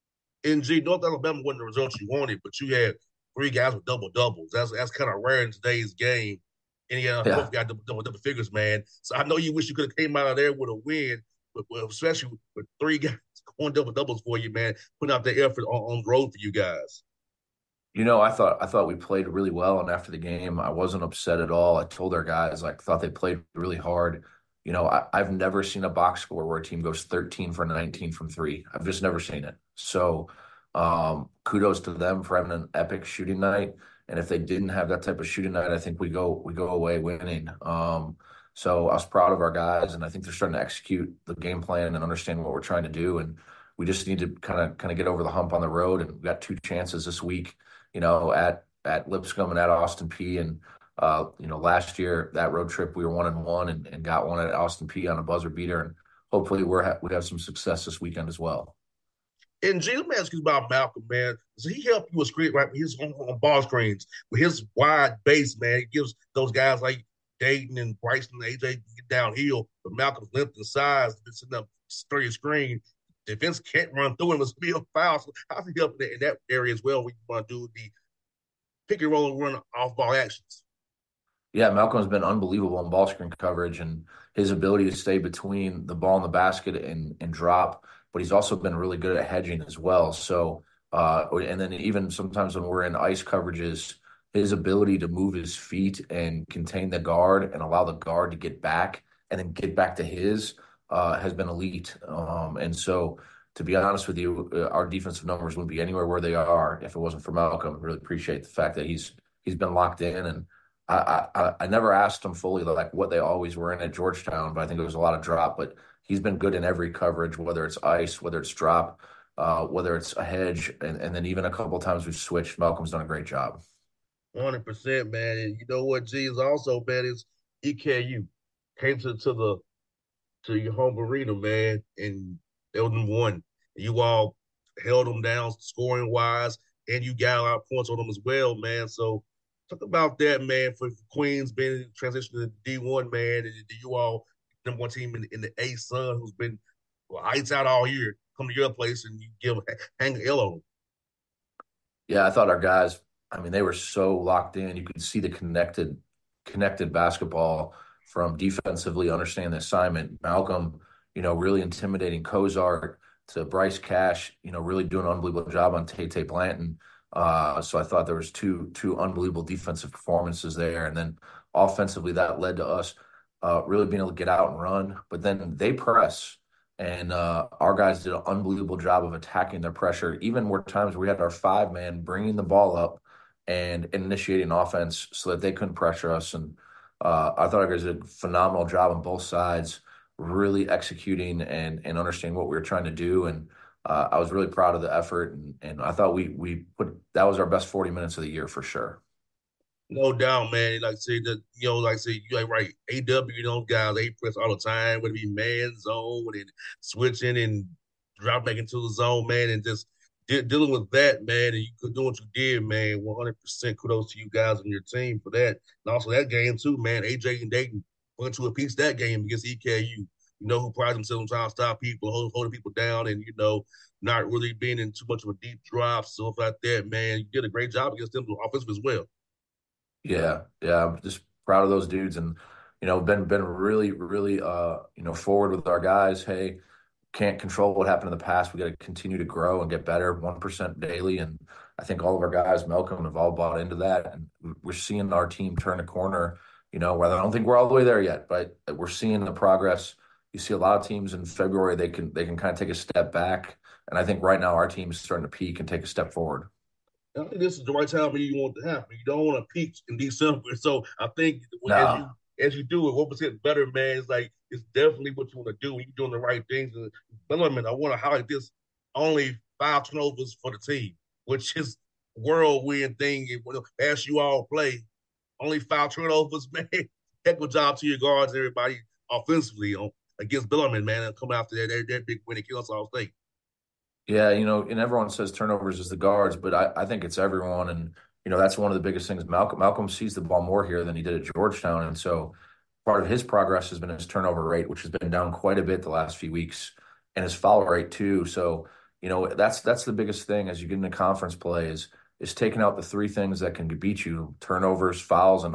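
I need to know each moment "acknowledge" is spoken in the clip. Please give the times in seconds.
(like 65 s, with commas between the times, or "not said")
not said.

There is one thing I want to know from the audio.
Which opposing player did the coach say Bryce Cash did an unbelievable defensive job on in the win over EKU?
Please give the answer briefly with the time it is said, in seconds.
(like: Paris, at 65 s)
Tay Tay Blanton, at 165 s.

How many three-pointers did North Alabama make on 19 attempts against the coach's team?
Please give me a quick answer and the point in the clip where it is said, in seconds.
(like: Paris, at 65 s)
13, at 27 s.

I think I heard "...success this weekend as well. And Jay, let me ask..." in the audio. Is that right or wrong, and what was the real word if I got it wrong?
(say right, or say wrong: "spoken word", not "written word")
right.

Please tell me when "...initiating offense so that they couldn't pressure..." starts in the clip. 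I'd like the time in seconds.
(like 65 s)
183 s.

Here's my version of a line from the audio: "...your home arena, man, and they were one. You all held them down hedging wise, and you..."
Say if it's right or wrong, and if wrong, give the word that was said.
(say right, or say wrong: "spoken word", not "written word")
wrong: "scoring", not "hedging".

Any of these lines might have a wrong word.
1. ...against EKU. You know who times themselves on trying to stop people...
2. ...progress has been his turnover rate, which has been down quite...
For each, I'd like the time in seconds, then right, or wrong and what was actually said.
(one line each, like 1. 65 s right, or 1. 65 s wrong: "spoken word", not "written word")
1. 219 s wrong: "prides", not "times"
2. 293 s right.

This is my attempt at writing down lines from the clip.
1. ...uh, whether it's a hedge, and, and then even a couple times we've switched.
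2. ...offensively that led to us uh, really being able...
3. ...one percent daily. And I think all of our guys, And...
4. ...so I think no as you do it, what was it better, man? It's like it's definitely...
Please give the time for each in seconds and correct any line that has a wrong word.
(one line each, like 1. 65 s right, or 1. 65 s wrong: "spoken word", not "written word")
1. 119 s right
2. 171 s right
3. 240 s wrong: "Malcolm", not "And"
4. 260 s right.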